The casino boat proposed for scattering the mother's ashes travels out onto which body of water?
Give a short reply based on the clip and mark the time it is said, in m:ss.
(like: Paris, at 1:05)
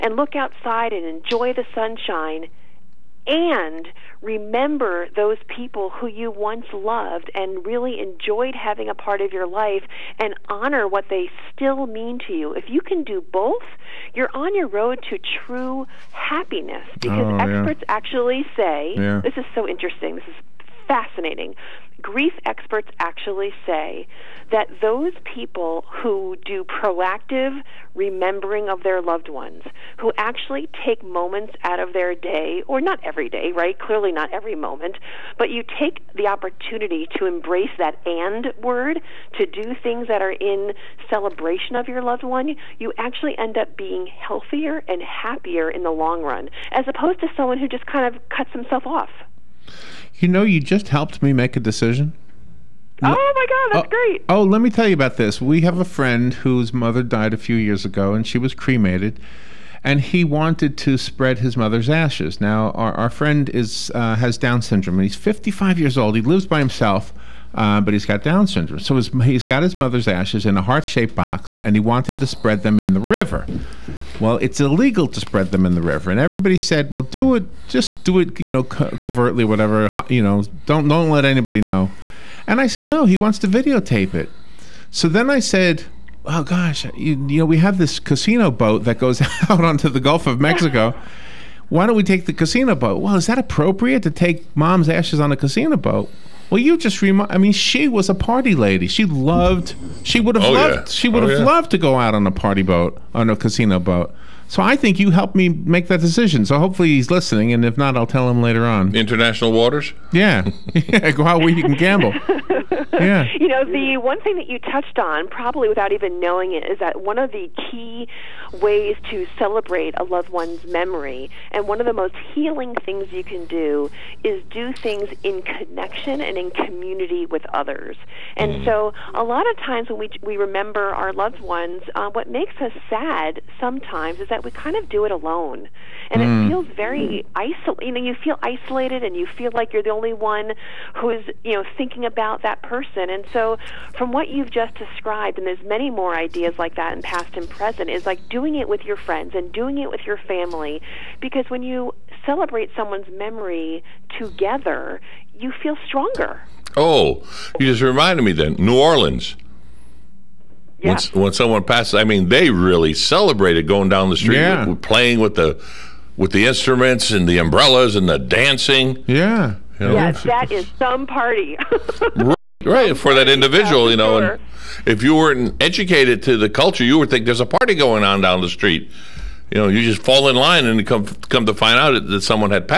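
Gulf of Mexico, at 1:30.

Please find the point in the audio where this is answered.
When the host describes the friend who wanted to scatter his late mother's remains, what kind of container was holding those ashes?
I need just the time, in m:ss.
1:10.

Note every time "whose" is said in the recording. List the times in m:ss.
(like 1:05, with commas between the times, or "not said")
0:56.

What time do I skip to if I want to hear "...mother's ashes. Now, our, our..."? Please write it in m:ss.
1:01.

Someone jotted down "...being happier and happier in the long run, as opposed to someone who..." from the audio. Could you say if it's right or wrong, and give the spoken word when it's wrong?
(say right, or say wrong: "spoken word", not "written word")
wrong: "healthier", not "happier".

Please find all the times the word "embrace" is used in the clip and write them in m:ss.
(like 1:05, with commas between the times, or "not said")
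0:37.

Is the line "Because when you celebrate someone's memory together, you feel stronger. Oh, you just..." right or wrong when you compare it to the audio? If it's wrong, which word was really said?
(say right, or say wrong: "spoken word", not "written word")
right.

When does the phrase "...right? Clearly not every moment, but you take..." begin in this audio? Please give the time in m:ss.
0:33.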